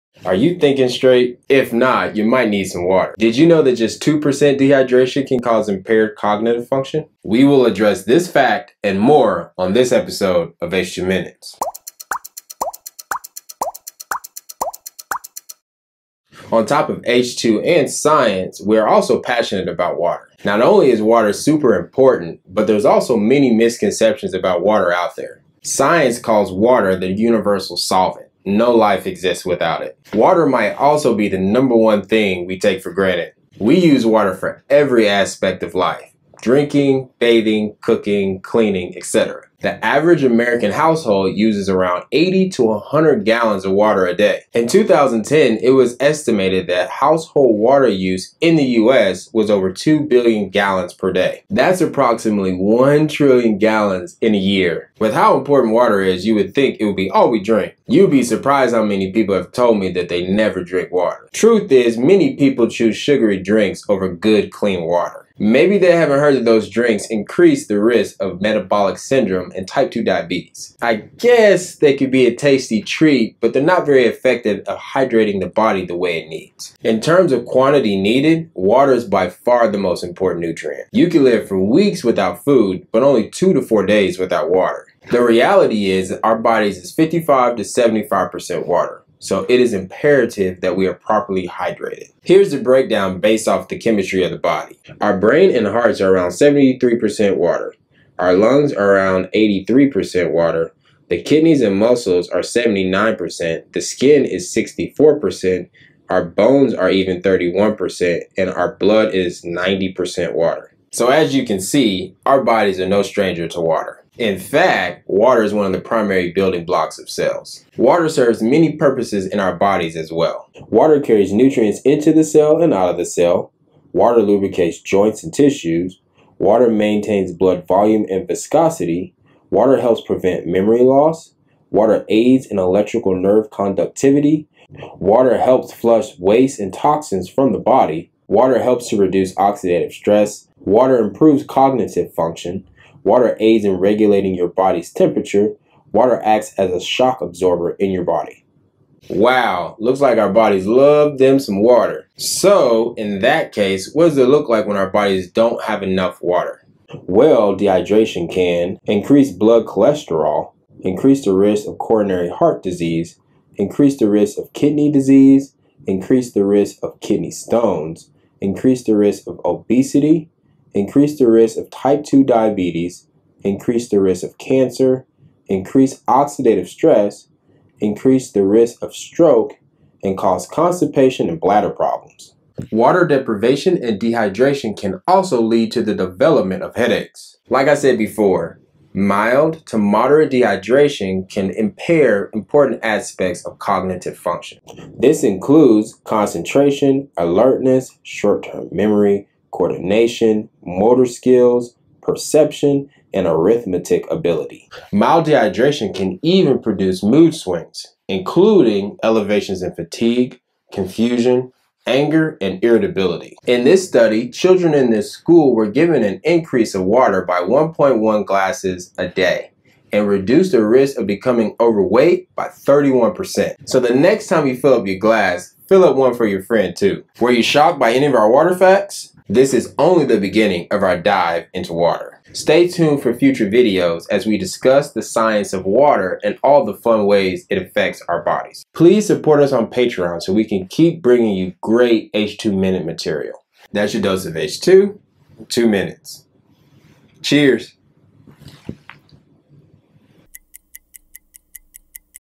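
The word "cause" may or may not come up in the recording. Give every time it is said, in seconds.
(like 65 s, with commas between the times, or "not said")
5 s, 180 s.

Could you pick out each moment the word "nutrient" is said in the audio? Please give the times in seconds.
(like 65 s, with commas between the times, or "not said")
80 s, 121 s.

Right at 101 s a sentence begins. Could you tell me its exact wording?
The kidneys and muscles are 79%.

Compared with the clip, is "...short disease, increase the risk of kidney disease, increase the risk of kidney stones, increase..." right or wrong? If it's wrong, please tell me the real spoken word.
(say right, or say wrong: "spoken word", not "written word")
wrong: "heart", not "short".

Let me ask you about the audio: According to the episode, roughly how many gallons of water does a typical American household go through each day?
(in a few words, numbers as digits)
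80 to 100 gallons.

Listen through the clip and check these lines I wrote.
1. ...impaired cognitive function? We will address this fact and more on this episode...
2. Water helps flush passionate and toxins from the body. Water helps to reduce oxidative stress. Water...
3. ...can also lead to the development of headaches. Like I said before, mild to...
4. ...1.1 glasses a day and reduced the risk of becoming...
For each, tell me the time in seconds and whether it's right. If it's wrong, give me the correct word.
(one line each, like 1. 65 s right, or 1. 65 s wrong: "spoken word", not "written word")
1. 5 s right
2. 134 s wrong: "waste", not "passionate"
3. 184 s right
4. 217 s right.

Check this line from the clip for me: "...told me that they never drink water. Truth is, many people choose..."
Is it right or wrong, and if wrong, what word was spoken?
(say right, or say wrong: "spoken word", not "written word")
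right.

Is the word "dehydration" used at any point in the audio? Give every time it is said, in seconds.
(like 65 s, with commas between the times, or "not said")
4 s, 157 s, 183 s, 190 s, 205 s.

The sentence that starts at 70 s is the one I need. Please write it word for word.
I guess they could be a tasty treat, but they're not very effective at hydrating the body the way it needs.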